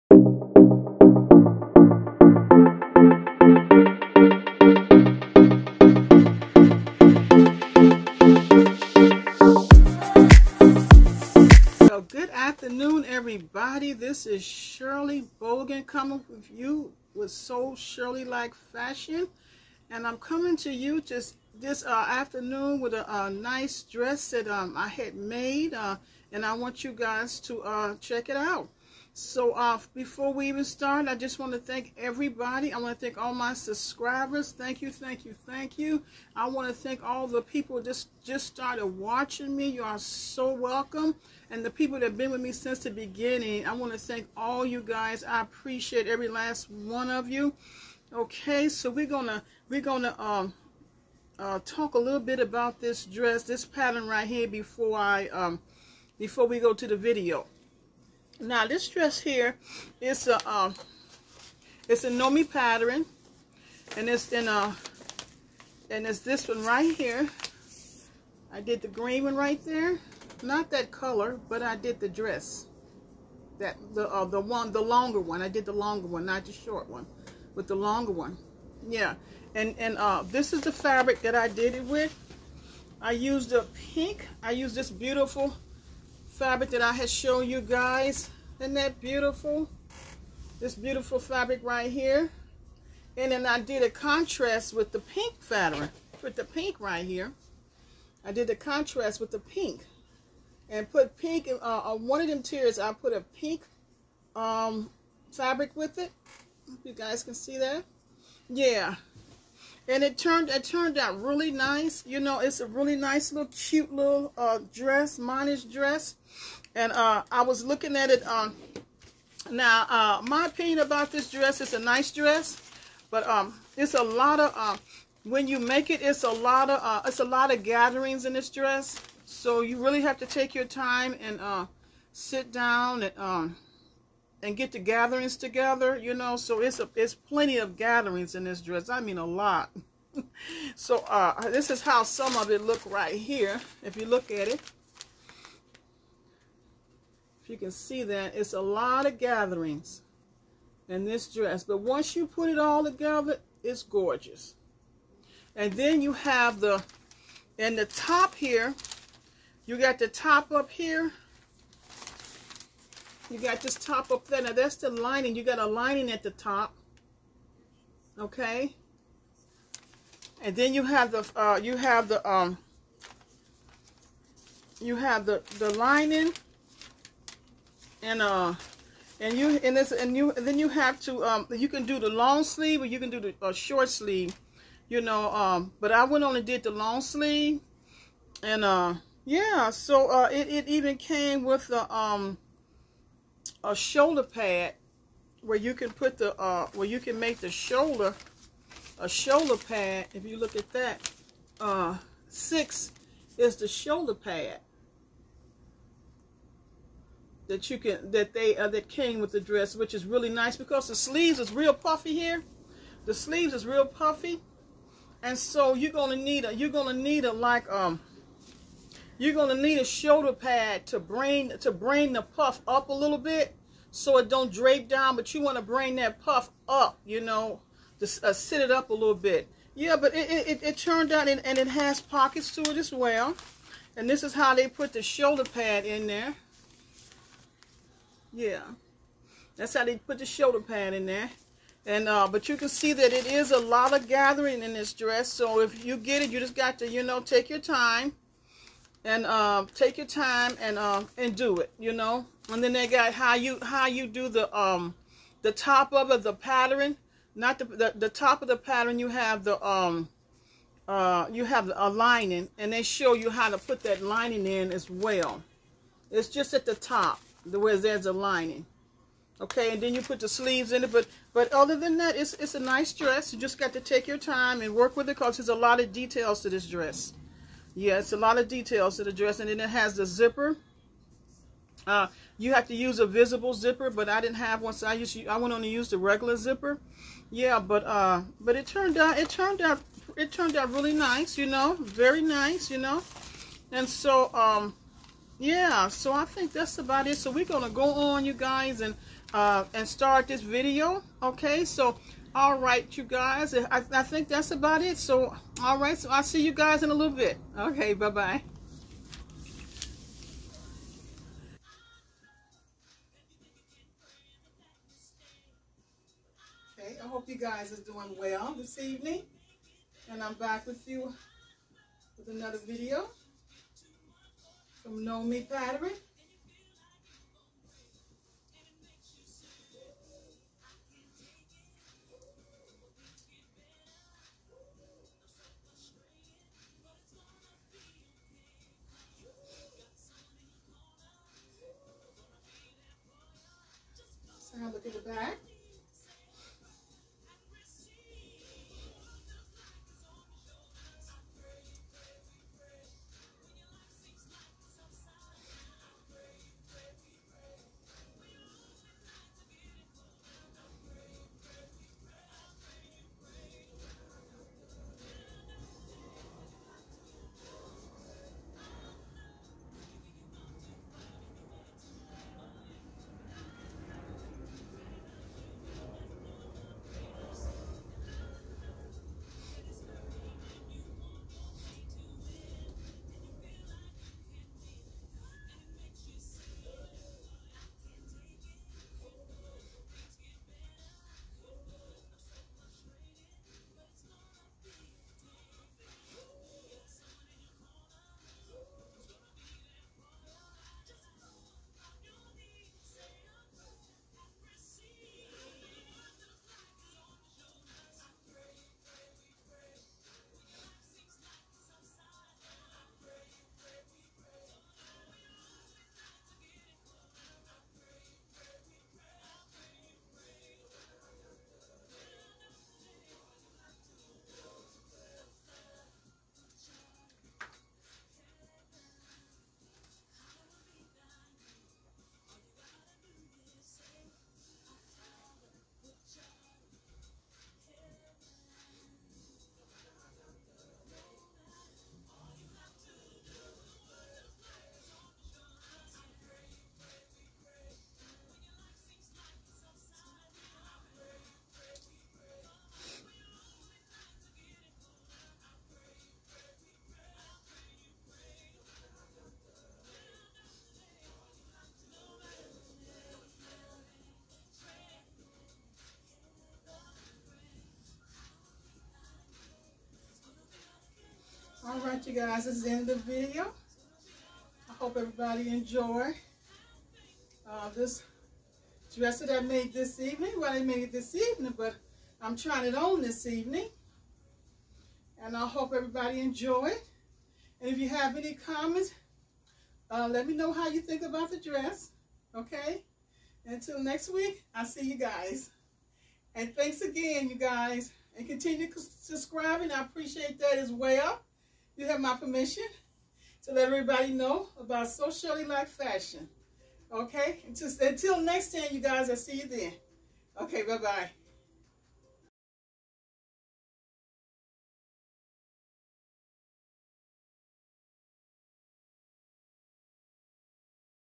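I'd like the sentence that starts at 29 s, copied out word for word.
So uh, before we even start, I just want to thank everybody.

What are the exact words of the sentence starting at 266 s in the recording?
It's just at the top, where there's a lining.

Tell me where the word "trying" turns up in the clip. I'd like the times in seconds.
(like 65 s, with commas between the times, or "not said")
482 s.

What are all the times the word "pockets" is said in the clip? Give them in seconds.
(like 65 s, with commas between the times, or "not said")
232 s.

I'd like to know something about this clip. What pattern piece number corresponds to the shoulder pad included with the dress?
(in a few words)
6.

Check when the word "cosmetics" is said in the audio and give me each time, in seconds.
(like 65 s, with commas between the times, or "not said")
not said.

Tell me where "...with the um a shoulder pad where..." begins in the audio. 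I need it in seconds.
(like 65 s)
191 s.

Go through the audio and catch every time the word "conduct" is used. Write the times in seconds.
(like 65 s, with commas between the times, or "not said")
not said.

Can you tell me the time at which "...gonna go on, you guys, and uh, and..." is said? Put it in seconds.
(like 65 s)
297 s.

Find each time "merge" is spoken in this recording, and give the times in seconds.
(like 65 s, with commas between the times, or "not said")
not said.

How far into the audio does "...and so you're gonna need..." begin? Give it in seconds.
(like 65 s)
215 s.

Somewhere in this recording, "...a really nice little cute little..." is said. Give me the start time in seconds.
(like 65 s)
112 s.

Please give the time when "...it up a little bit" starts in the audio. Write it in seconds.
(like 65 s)
228 s.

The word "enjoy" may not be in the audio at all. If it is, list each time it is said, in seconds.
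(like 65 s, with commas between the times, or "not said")
475 s, 486 s.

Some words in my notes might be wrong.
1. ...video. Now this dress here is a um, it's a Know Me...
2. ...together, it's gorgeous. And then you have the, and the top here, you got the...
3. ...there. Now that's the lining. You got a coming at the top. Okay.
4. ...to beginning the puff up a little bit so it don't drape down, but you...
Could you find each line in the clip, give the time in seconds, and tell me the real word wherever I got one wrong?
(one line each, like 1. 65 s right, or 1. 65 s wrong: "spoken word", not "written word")
1. 56 s right
2. 152 s right
3. 164 s wrong: "lining", not "coming"
4. 221 s wrong: "bring", not "beginning".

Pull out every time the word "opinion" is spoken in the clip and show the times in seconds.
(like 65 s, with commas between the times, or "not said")
120 s.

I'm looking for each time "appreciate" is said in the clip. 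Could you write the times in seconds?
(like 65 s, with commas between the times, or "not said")
45 s, 499 s.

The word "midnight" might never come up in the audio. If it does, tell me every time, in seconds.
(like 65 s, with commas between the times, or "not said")
not said.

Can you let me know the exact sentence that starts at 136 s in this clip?
So it's a, it's plenty of gatherings in this dress.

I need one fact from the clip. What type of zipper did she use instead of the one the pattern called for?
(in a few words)
Regular zipper.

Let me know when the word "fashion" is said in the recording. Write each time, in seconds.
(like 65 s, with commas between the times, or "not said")
18 s, 505 s.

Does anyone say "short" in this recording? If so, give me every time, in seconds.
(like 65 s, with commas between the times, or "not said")
76 s, 183 s.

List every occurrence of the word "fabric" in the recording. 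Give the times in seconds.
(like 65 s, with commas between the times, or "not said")
80 s, 86 s, 91 s, 95 s, 105 s.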